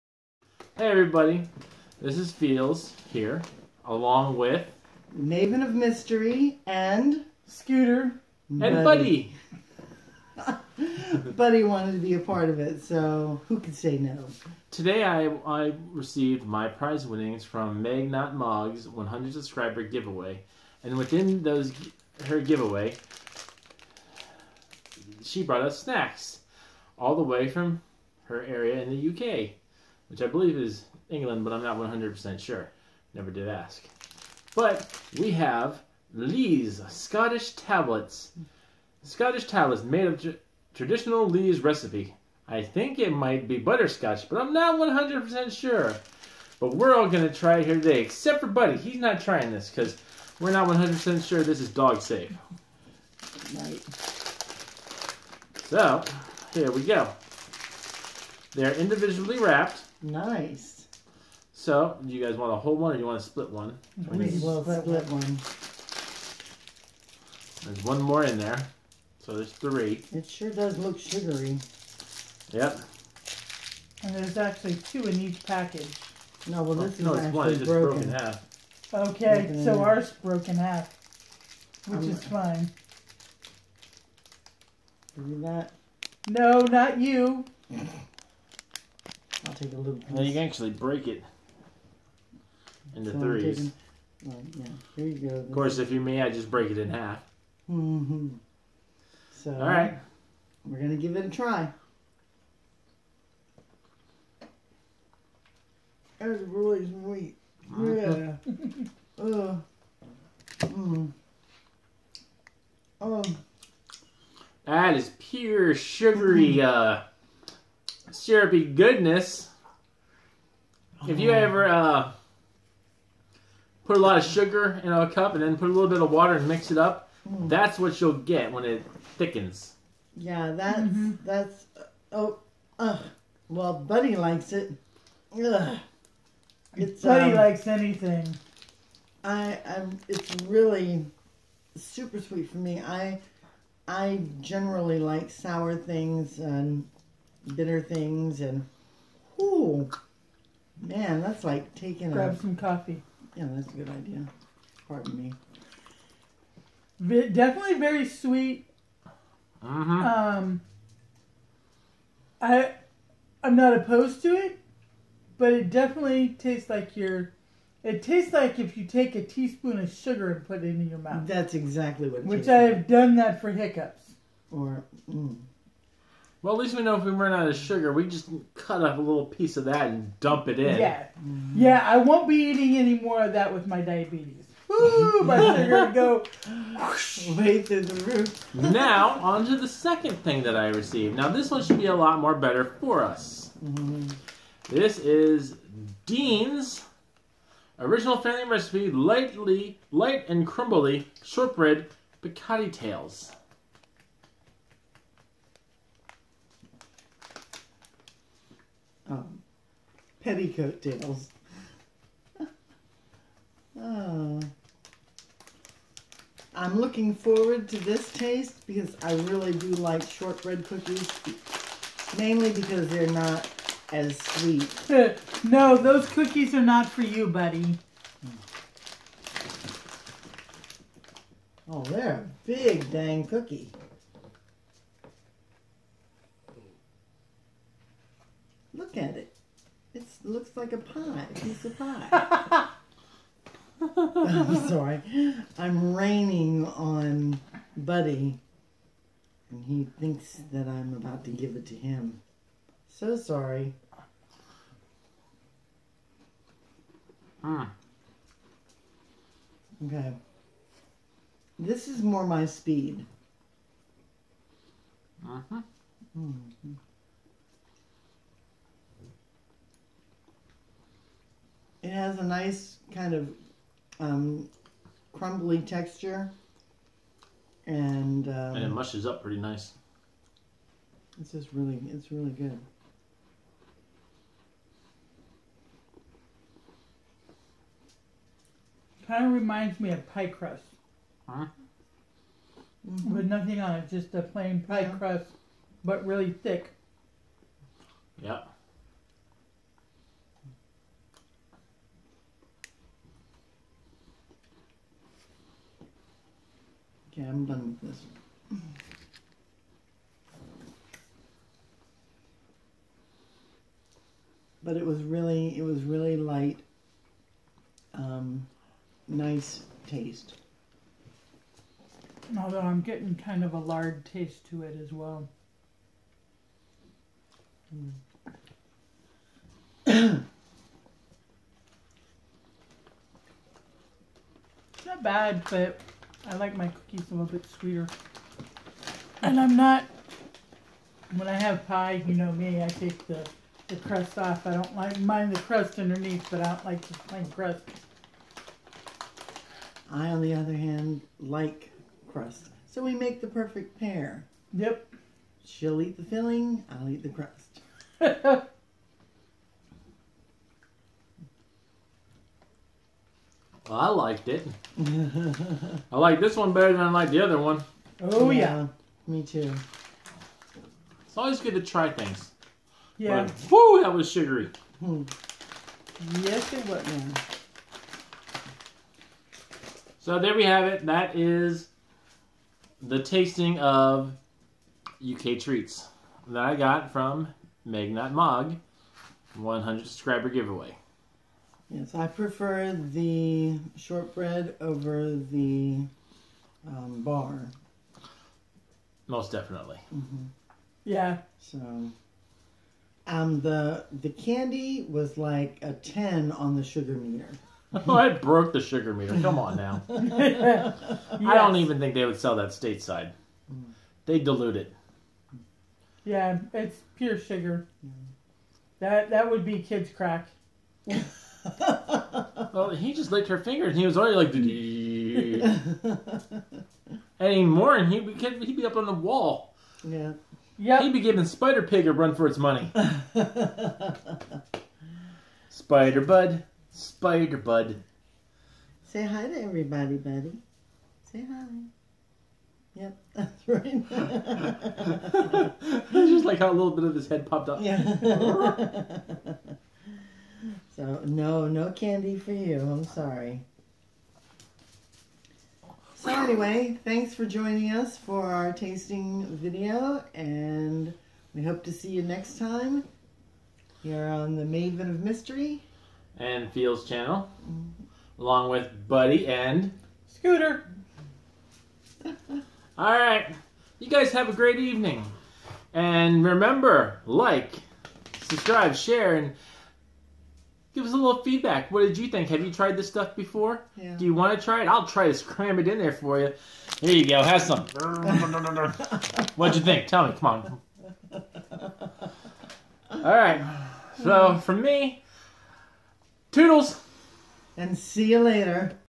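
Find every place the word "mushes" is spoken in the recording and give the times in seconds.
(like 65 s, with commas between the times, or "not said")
278 s.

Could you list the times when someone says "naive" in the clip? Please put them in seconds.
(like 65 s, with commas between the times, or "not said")
not said.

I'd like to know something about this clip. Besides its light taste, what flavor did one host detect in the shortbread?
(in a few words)
lard.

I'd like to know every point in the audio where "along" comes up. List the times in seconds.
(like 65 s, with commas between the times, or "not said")
3 s, 468 s.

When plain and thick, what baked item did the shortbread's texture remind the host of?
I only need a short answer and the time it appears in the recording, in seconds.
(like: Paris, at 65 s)
pie crust, at 290 s.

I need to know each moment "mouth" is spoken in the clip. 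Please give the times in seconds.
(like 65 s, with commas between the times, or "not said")
170 s.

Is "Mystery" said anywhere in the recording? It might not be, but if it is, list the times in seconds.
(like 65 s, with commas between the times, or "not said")
5 s, 465 s.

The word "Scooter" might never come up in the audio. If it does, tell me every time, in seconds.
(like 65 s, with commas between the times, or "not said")
7 s, 470 s.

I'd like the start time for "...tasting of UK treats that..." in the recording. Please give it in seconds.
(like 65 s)
383 s.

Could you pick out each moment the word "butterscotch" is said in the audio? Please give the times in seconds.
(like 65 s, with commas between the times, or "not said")
43 s.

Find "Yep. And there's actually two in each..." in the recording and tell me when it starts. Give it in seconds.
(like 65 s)
72 s.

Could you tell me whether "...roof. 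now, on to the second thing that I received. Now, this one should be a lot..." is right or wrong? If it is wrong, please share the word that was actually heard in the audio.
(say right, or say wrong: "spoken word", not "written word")
right.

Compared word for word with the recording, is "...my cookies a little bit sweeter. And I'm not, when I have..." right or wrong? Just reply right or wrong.
right.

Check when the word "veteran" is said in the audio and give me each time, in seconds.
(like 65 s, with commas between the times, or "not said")
not said.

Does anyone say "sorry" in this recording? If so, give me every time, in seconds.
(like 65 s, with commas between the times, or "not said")
244 s, 253 s, 452 s.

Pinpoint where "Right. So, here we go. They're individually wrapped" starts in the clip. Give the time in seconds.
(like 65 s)
53 s.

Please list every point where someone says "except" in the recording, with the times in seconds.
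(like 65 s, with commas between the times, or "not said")
48 s.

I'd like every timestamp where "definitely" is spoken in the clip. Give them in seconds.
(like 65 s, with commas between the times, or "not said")
157 s, 165 s, 399 s.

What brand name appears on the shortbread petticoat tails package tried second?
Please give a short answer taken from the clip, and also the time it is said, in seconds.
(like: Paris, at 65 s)
Dean's, at 196 s.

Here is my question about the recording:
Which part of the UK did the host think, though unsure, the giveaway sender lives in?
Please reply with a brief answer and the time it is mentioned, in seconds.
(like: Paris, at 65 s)
England, at 31 s.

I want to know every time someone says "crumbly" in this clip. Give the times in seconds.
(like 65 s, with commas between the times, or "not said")
200 s, 275 s.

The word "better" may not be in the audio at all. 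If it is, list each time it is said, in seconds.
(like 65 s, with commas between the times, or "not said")
192 s, 366 s.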